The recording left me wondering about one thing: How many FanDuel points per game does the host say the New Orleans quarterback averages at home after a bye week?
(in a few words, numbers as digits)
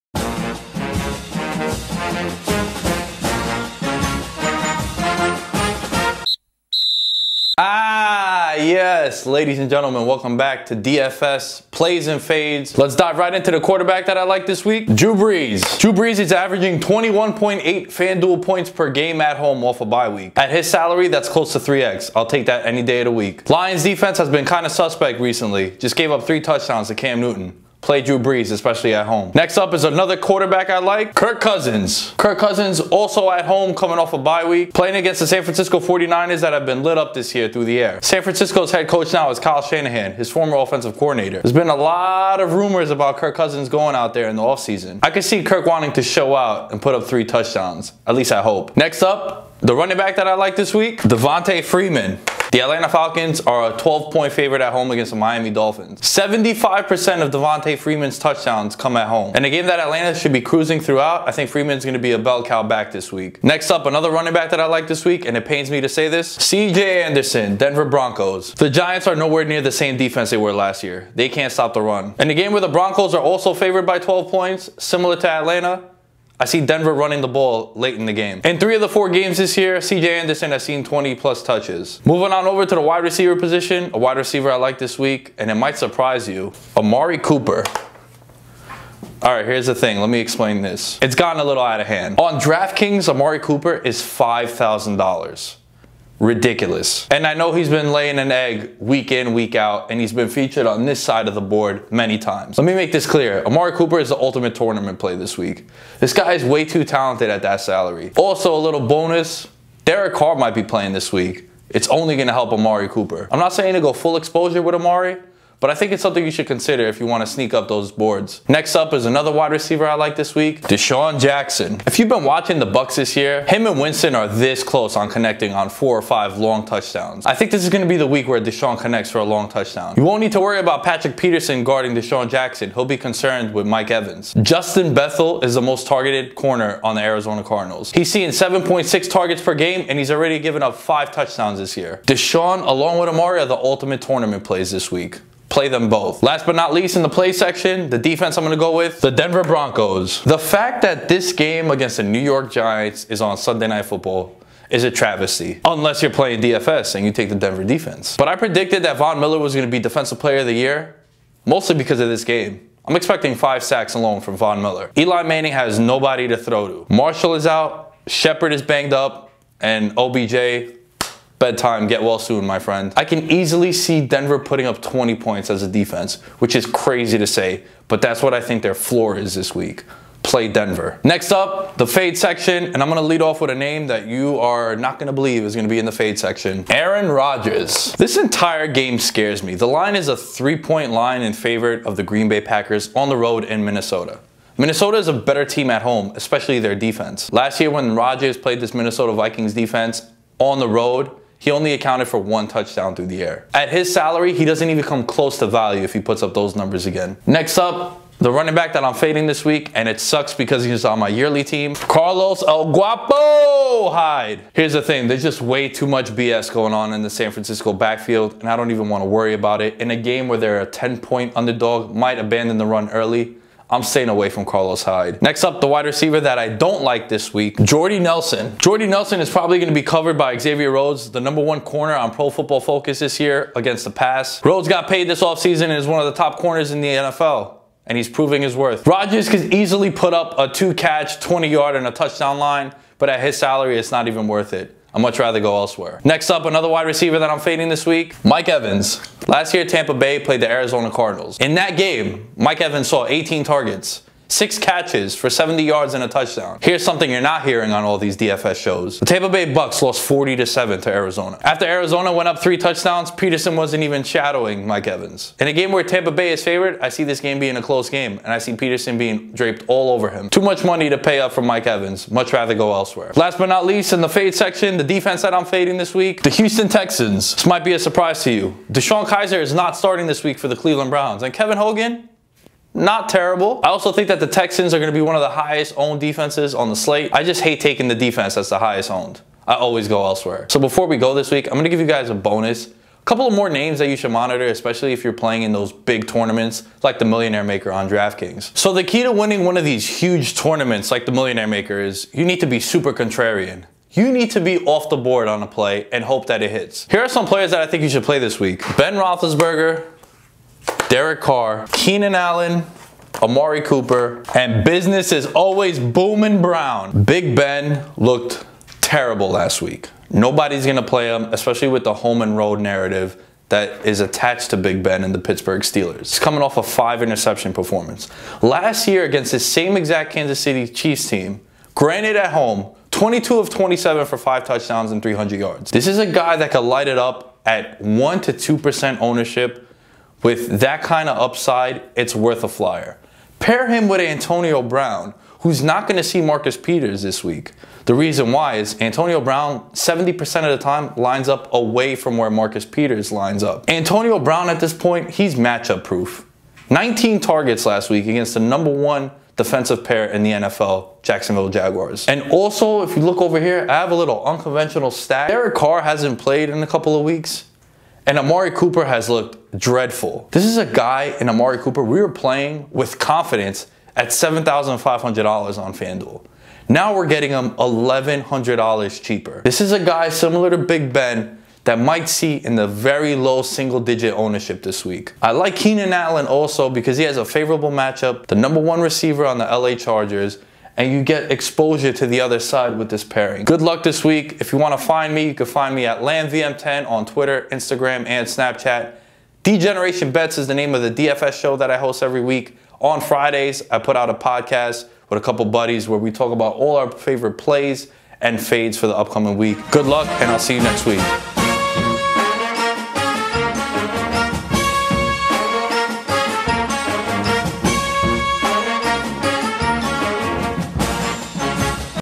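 21.8.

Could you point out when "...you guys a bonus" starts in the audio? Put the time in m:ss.
4:51.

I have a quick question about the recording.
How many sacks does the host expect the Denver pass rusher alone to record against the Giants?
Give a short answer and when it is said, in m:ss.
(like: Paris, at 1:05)
5, at 2:43.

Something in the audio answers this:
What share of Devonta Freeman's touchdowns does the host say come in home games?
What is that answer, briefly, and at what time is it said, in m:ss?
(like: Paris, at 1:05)
75%, at 0:56.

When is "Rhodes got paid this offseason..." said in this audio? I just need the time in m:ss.
3:54.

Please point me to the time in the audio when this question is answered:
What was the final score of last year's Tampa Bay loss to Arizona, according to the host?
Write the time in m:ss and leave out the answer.
4:20.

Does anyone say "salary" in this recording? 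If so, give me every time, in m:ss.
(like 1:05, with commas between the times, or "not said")
0:20, 1:47, 3:23, 4:03.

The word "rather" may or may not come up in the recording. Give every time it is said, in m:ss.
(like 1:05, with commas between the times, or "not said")
4:05, 4:32.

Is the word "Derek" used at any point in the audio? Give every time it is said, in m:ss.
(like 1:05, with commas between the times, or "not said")
1:49, 5:10, 6:05.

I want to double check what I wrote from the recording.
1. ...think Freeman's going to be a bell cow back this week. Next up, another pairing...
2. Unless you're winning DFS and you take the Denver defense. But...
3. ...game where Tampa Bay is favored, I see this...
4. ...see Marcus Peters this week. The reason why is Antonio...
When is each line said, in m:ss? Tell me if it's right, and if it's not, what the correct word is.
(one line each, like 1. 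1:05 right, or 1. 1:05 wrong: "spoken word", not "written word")
1. 1:01 wrong: "running", not "pairing"
2. 2:35 wrong: "playing", not "winning"
3. 4:25 right
4. 5:46 right.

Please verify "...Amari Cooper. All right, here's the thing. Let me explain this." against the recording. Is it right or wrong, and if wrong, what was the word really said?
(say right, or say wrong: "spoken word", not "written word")
right.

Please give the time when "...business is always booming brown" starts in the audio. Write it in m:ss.
5:14.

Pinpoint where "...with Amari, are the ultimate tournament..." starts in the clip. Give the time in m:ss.
2:22.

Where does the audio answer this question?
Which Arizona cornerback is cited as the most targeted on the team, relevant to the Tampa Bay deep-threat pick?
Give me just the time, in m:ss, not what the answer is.
2:14.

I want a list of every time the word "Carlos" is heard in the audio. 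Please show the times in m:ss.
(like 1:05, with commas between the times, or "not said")
3:31, 3:44.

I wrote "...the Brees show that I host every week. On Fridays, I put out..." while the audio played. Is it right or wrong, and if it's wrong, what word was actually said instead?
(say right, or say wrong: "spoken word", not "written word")
wrong: "DFS", not "Brees".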